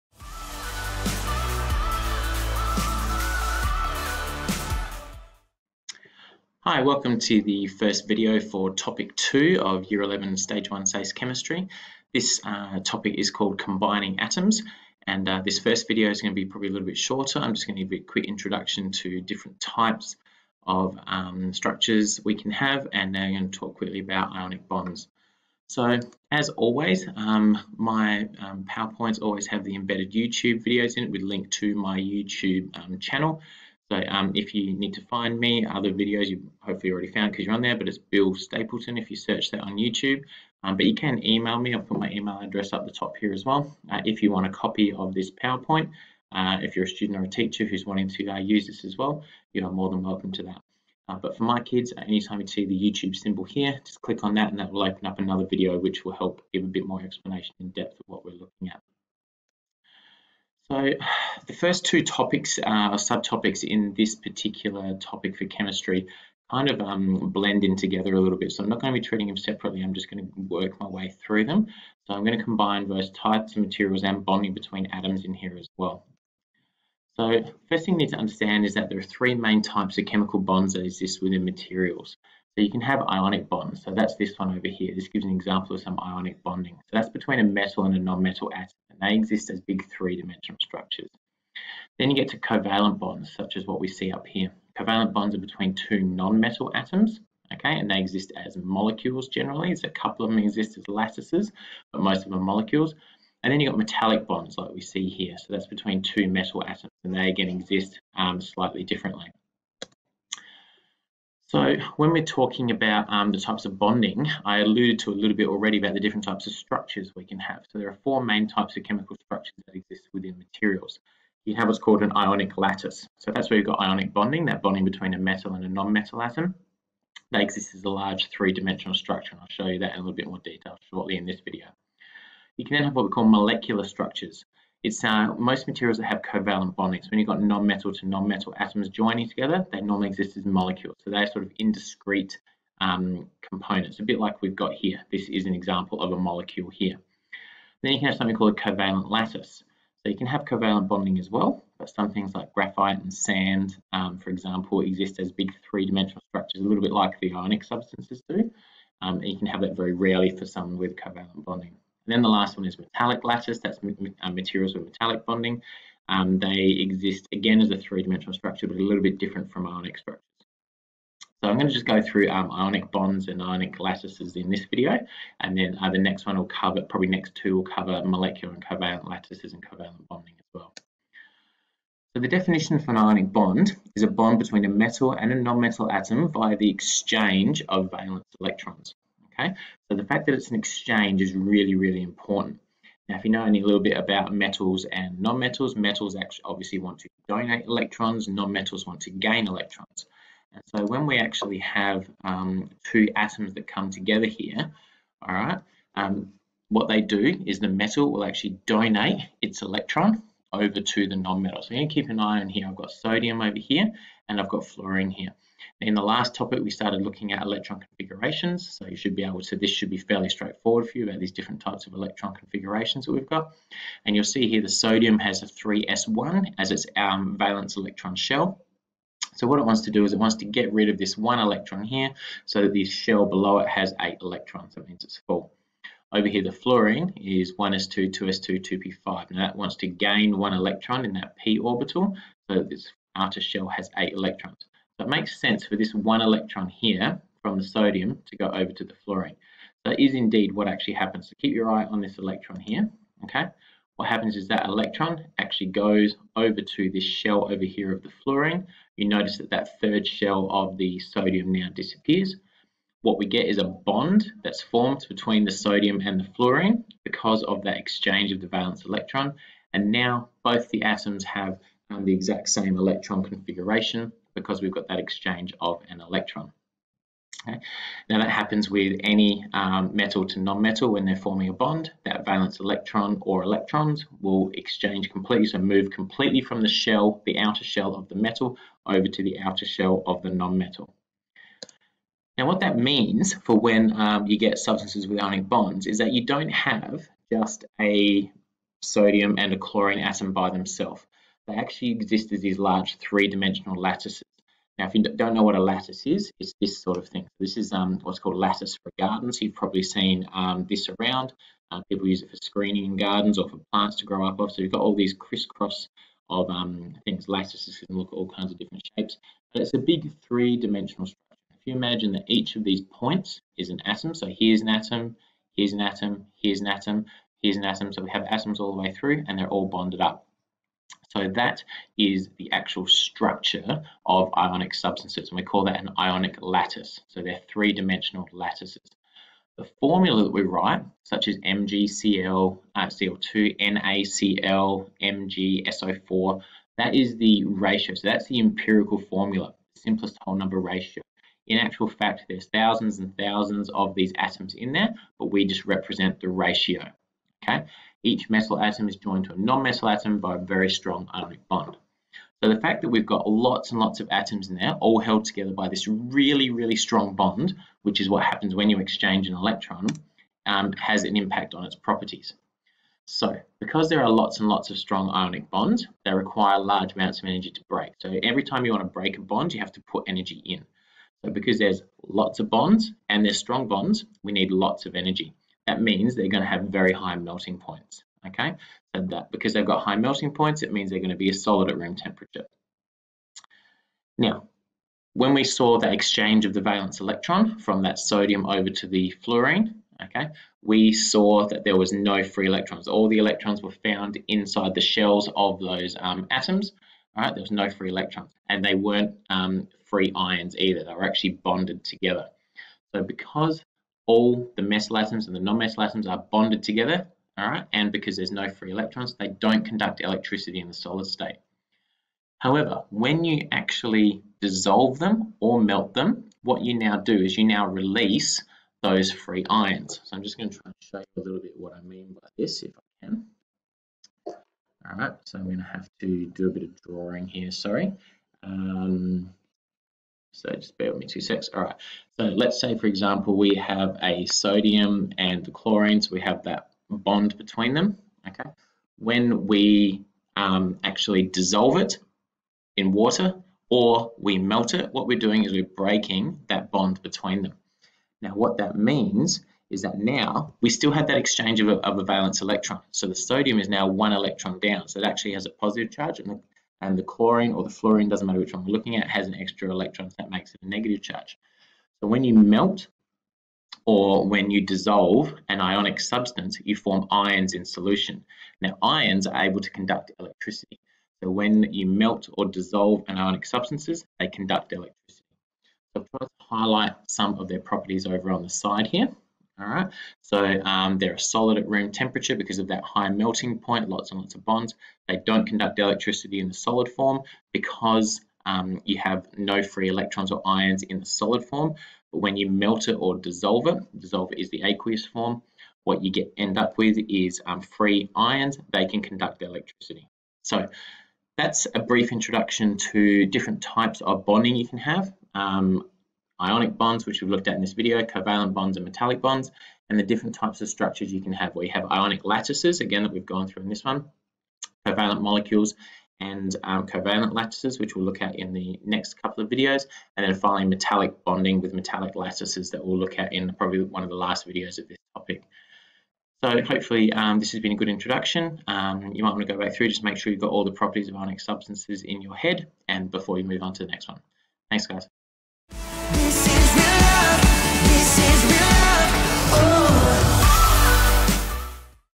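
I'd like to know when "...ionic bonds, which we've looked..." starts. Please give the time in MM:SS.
08:36.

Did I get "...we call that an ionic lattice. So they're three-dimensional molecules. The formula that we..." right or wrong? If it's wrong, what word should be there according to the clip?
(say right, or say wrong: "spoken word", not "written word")
wrong: "lattices", not "molecules".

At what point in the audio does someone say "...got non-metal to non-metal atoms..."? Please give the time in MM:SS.
02:17.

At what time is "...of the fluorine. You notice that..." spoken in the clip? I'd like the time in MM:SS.
04:17.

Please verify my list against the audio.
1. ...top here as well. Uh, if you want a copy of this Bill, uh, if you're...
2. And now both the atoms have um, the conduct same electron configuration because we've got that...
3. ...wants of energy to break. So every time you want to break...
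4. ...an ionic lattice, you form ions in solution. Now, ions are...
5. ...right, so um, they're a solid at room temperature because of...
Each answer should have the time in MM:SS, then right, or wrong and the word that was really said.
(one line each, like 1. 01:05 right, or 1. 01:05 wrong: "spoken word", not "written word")
1. 00:42 wrong: "PowerPoint", not "Bill"
2. 04:29 wrong: "exact", not "conduct"
3. 06:16 wrong: "amounts", not "wants"
4. 07:55 wrong: "substance", not "lattice"
5. 08:09 right.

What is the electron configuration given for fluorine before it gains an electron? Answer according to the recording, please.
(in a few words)
1s2 2s2 2p5.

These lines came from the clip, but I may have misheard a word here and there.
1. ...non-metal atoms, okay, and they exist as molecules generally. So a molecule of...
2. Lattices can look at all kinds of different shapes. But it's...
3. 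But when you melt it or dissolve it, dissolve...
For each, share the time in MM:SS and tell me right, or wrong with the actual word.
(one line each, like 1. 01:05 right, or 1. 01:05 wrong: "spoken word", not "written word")
1. 01:36 wrong: "couple", not "molecule"
2. 05:17 right
3. 08:22 right.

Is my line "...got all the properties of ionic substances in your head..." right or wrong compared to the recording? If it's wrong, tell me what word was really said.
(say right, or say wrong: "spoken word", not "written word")
right.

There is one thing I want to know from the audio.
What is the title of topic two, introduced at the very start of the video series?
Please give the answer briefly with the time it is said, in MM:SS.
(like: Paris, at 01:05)
Combining atoms, at 00:13.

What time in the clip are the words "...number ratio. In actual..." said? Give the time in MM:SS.
05:50.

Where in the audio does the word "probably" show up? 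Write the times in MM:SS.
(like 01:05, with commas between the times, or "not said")
00:16, 02:56, 05:09, 08:53.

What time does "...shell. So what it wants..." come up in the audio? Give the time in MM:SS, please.
03:48.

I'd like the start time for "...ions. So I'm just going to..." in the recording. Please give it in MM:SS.
07:09.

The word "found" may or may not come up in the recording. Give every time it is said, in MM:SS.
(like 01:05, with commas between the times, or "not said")
00:37, 06:43.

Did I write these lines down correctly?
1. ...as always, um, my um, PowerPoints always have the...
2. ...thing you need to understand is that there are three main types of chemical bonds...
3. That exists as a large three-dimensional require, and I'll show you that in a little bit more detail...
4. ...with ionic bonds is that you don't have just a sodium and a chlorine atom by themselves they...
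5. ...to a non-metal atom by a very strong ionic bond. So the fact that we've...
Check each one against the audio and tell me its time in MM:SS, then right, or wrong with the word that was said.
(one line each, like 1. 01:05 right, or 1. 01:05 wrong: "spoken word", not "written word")
1. 00:26 right
2. 01:17 right
3. 02:07 wrong: "structure", not "require"
4. 04:55 right
5. 05:59 right.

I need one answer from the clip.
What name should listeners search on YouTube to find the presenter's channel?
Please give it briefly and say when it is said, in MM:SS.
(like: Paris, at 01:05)
Bill Stapleton, at 00:37.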